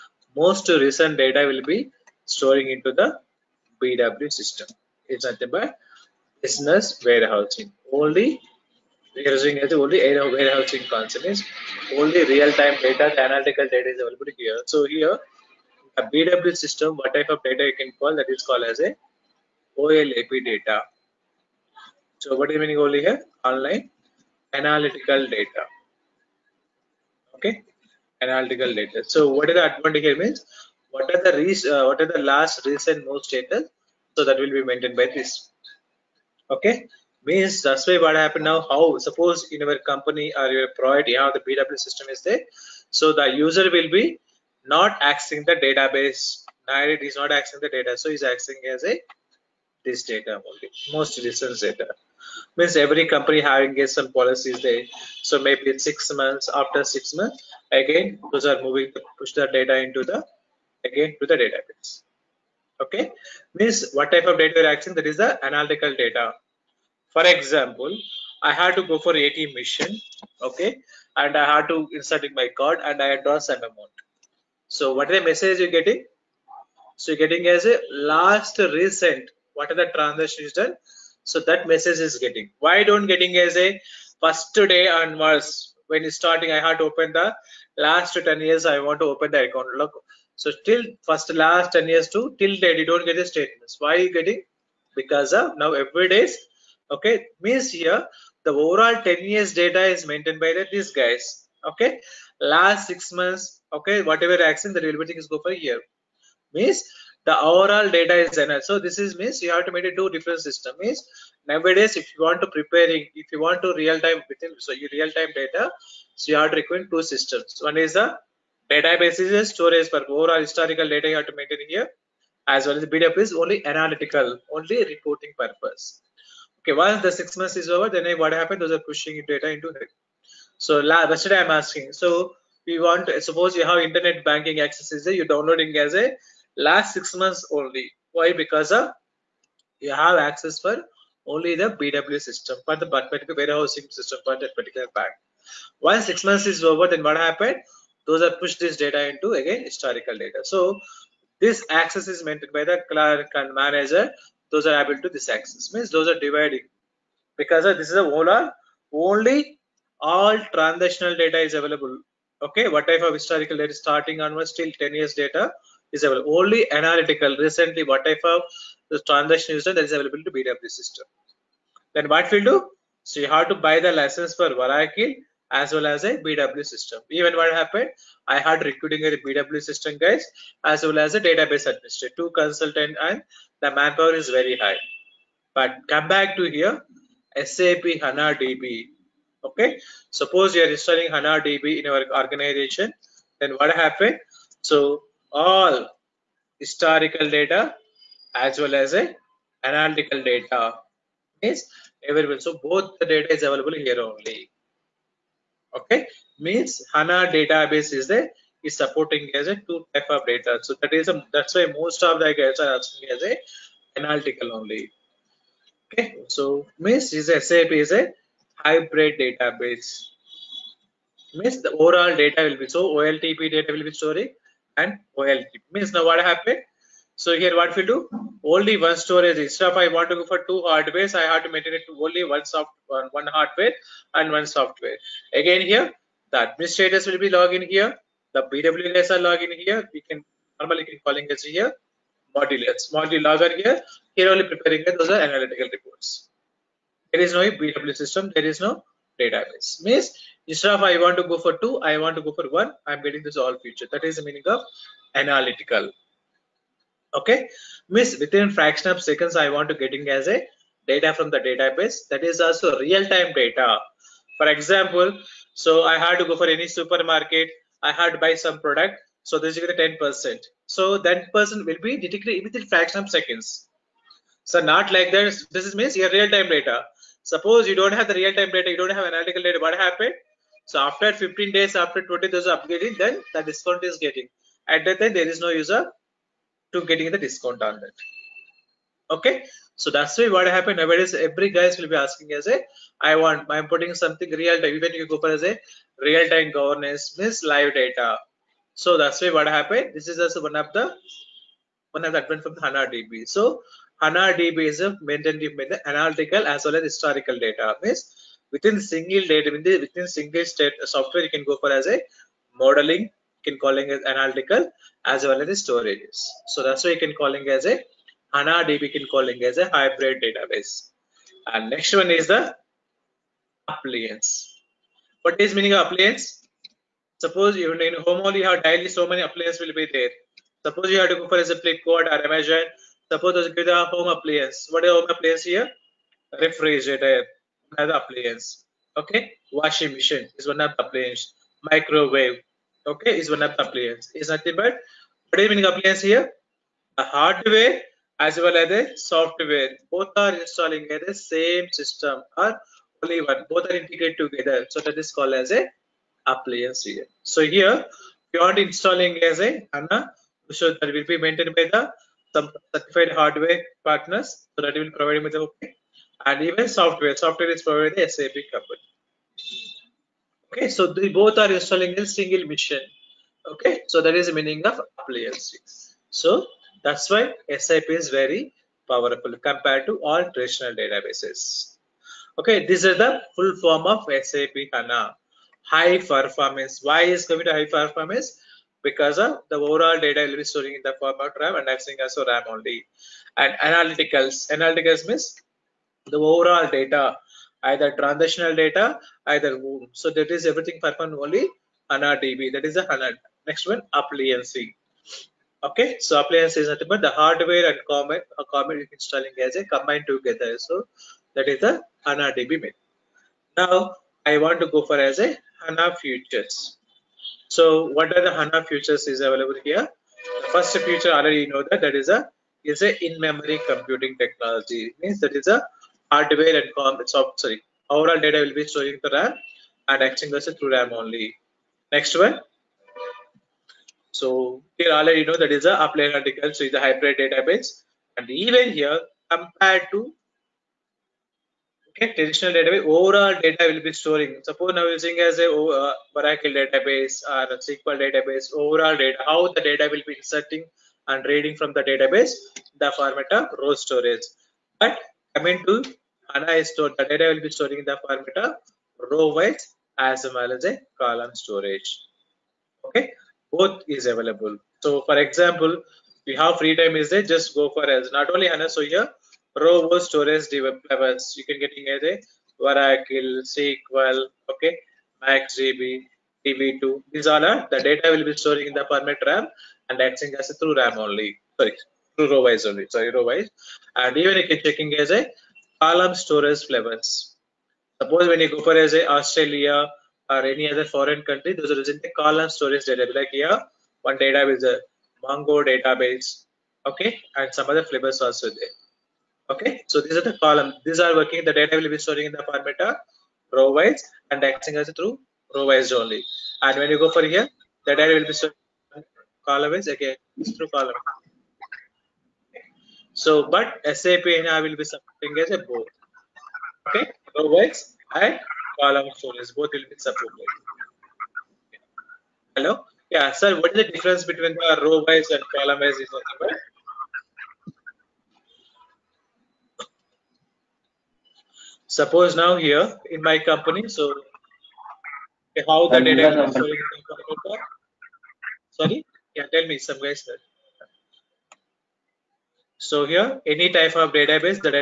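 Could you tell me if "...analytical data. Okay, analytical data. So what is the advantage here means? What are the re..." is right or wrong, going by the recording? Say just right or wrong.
right.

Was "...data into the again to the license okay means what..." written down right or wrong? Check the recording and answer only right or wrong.
wrong.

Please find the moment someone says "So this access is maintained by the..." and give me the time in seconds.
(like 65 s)
150 s.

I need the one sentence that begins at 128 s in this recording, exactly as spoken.
Those are pushing data into it.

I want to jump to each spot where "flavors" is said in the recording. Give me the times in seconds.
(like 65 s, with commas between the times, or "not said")
486 s, 497 s.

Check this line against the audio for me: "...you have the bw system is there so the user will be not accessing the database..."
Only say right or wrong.
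right.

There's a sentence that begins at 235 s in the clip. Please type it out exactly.
Again here, the administrators will be logging in here.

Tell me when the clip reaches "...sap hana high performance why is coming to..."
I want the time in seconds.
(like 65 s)
384 s.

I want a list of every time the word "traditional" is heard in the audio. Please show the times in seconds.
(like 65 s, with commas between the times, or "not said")
380 s, 442 s.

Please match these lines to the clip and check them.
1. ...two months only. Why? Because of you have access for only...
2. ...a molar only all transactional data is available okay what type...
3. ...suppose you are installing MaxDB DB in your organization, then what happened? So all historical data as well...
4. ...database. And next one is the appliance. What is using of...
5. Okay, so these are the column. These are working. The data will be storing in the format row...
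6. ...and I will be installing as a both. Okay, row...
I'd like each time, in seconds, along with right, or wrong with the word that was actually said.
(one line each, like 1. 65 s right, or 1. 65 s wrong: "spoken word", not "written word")
1. 136 s wrong: "six", not "two"
2. 158 s right
3. 190 s wrong: "HANA", not "MaxDB"
4. 320 s wrong: "meaning", not "using"
5. 499 s right
6. 514 s wrong: "supporting", not "installing".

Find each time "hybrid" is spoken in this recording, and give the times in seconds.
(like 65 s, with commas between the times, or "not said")
218 s, 319 s, 436 s.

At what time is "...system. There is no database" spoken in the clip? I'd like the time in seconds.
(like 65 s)
247 s.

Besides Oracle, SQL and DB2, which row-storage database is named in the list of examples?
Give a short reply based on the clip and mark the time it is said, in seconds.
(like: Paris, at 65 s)
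MaxDB, at 475 s.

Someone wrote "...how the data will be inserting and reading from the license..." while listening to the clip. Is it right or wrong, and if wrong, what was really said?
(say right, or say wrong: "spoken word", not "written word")
wrong: "database", not "license".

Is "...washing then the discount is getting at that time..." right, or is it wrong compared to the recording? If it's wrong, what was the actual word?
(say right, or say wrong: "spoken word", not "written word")
wrong: "upgrading", not "washing".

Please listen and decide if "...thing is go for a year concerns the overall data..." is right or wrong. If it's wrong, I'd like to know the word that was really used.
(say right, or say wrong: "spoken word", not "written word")
wrong: "means", not "concerns".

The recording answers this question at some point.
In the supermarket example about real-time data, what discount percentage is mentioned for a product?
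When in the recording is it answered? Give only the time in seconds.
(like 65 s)
269 s.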